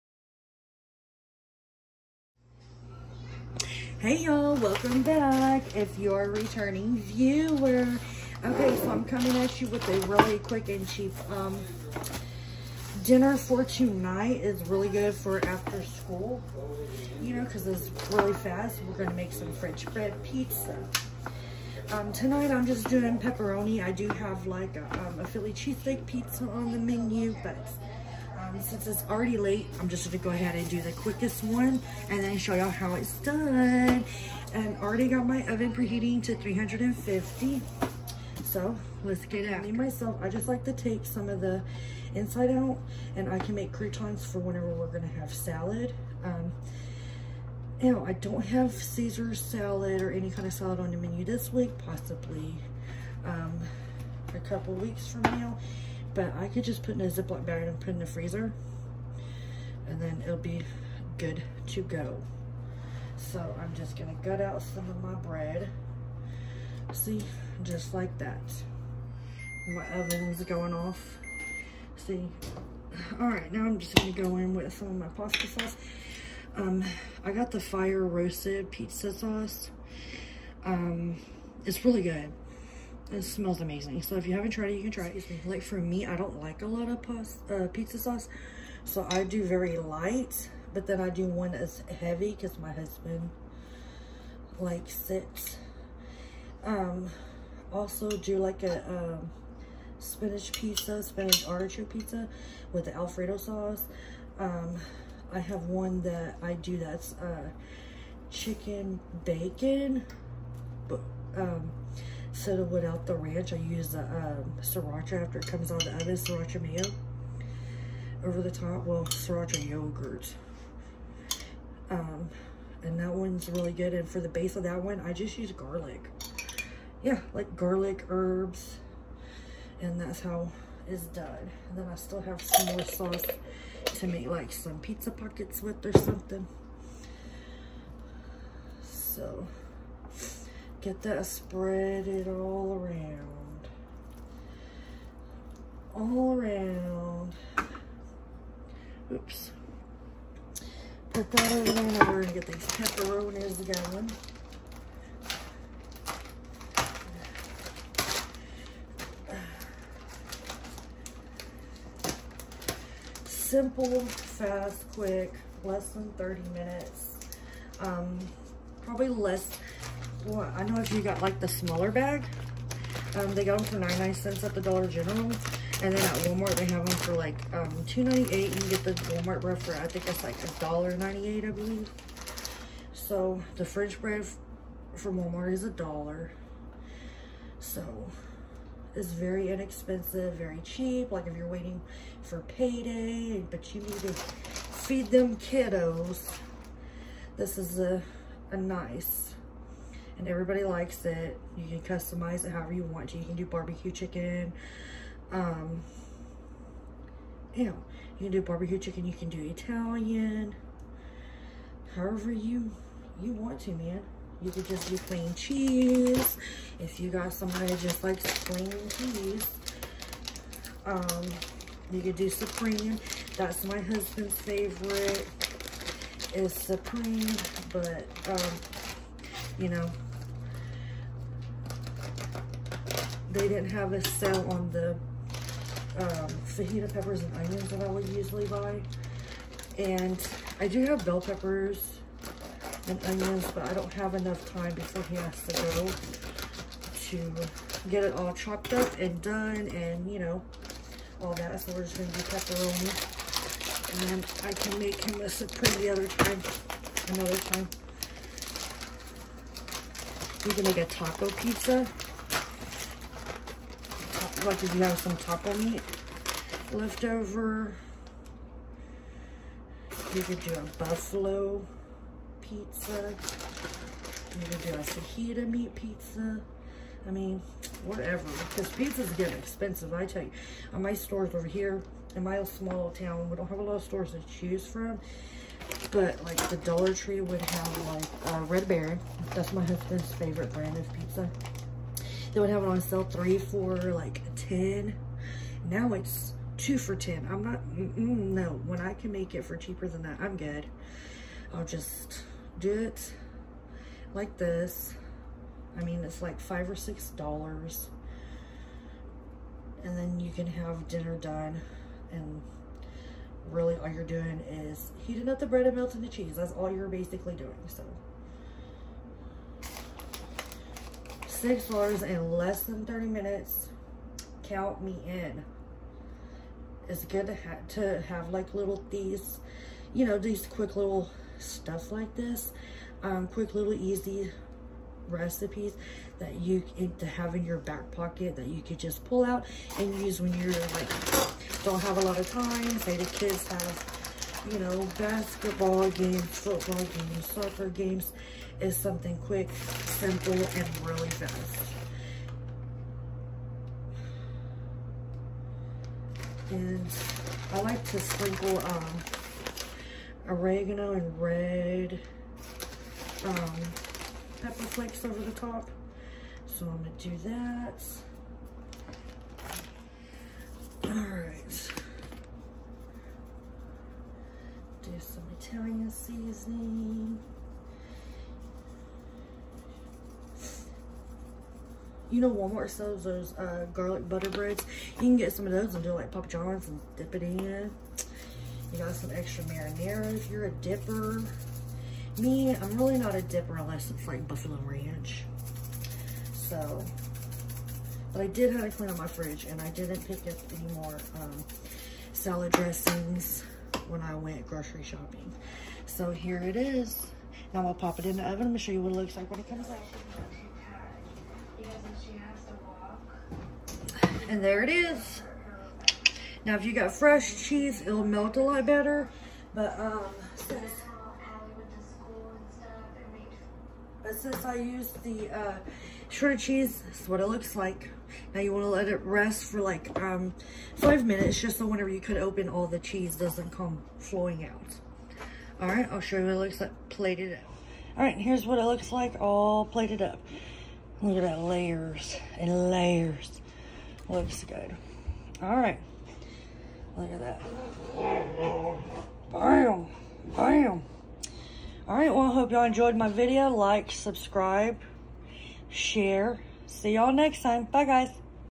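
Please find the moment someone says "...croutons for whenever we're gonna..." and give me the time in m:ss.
0:43.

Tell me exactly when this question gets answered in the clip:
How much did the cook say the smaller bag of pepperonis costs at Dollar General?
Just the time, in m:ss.
2:53.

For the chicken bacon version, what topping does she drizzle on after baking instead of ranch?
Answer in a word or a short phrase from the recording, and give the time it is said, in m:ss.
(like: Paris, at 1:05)
sriracha yogurt, at 1:59.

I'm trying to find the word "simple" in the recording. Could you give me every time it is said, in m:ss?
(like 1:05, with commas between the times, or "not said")
2:43, 5:49.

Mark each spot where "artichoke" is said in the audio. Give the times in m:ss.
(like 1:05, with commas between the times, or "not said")
1:41.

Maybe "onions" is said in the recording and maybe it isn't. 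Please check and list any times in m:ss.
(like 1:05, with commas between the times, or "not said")
3:57, 4:03.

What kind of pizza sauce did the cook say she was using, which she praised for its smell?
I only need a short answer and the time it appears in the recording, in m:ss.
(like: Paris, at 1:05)
fire roasted pizza sauce, at 1:17.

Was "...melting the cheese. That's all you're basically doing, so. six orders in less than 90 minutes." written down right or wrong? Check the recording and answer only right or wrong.
wrong.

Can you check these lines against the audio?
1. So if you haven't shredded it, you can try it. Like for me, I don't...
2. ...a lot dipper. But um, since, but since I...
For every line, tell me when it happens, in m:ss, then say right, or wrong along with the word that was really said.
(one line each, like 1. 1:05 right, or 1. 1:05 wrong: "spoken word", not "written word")
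1. 1:24 wrong: "tried", not "shredded"
2. 6:58 wrong: "better", not "dipper".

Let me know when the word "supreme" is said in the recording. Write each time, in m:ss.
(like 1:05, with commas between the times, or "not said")
3:42, 3:46, 4:15.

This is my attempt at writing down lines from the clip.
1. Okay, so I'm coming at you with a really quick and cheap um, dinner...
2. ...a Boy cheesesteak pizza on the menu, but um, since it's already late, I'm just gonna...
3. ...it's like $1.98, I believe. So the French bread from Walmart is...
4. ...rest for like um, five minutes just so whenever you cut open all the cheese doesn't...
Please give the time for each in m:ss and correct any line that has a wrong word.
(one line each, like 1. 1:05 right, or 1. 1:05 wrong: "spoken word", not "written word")
1. 0:08 right
2. 0:25 wrong: "Philly", not "Boy"
3. 3:00 right
4. 7:09 right.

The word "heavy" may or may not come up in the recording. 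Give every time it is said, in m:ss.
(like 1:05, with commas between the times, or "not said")
1:31.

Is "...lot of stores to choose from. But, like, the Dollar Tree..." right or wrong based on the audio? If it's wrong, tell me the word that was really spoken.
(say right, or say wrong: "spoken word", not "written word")
right.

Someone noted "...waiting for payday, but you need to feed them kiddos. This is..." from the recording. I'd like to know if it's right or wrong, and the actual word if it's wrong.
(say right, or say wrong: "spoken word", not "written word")
right.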